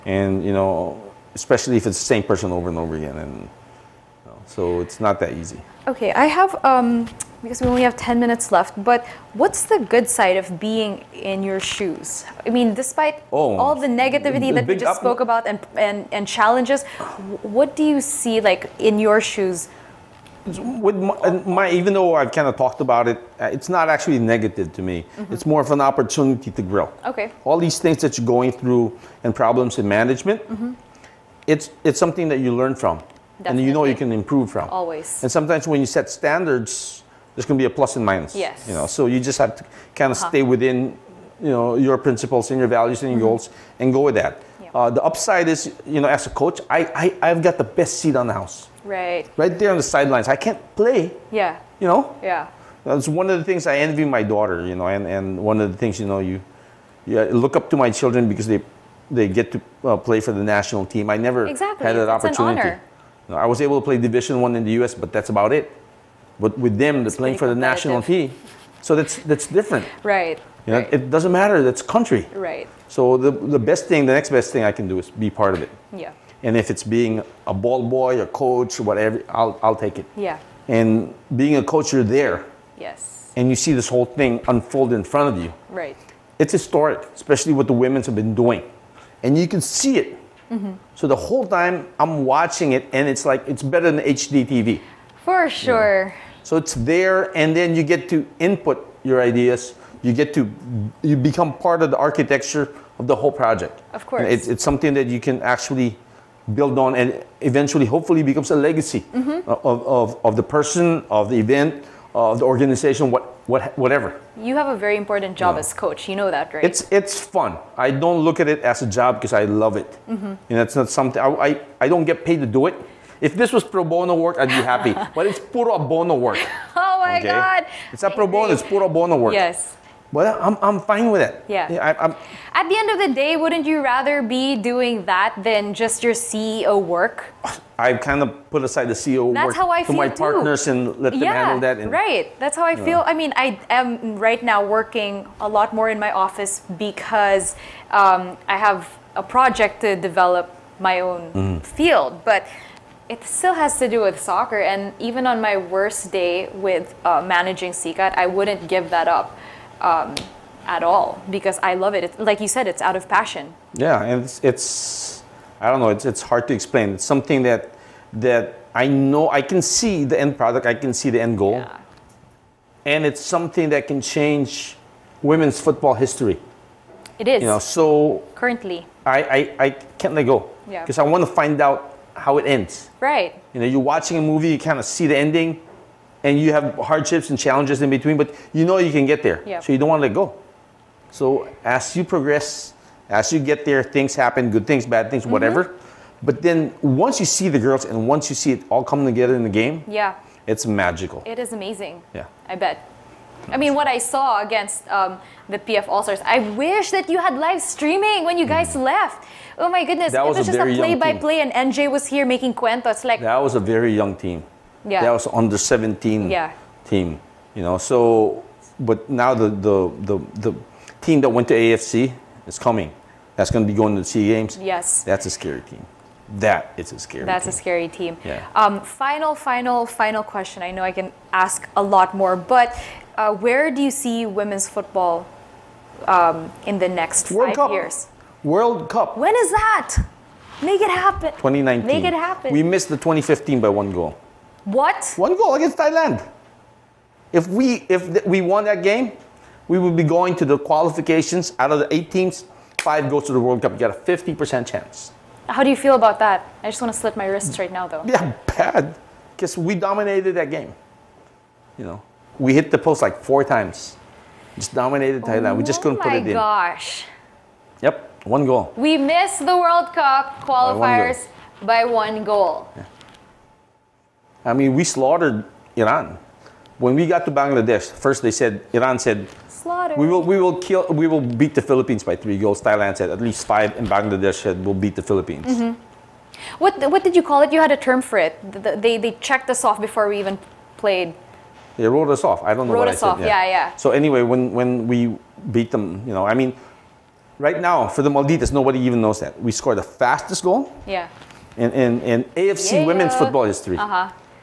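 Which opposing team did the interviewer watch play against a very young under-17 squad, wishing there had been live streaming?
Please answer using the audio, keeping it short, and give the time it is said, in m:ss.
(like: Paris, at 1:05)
PF All Stars, at 3:25.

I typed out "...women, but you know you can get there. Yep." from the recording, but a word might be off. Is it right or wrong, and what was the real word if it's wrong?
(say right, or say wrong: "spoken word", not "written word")
wrong: "between", not "women".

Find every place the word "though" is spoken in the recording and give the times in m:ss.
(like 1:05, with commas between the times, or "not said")
0:21, 4:17.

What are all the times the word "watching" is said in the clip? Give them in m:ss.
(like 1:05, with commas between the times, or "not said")
1:32, 3:03.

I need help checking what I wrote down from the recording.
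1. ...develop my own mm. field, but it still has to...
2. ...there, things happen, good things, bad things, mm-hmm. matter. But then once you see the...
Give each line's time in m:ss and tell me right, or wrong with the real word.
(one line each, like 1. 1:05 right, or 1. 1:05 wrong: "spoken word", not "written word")
1. 2:29 right
2. 3:13 wrong: "whatever", not "matter".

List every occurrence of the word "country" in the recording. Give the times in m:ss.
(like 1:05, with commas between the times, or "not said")
1:11.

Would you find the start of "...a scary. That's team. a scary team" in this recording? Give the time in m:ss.
3:46.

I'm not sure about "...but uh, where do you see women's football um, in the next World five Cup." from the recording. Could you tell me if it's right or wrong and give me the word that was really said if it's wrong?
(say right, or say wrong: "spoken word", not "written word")
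right.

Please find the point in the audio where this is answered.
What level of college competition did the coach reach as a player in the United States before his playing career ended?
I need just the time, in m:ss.
1:03.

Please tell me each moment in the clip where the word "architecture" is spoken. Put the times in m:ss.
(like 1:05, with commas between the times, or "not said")
1:41.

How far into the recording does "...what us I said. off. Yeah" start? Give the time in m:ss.
4:52.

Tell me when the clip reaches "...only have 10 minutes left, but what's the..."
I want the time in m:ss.
0:07.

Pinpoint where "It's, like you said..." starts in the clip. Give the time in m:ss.
2:42.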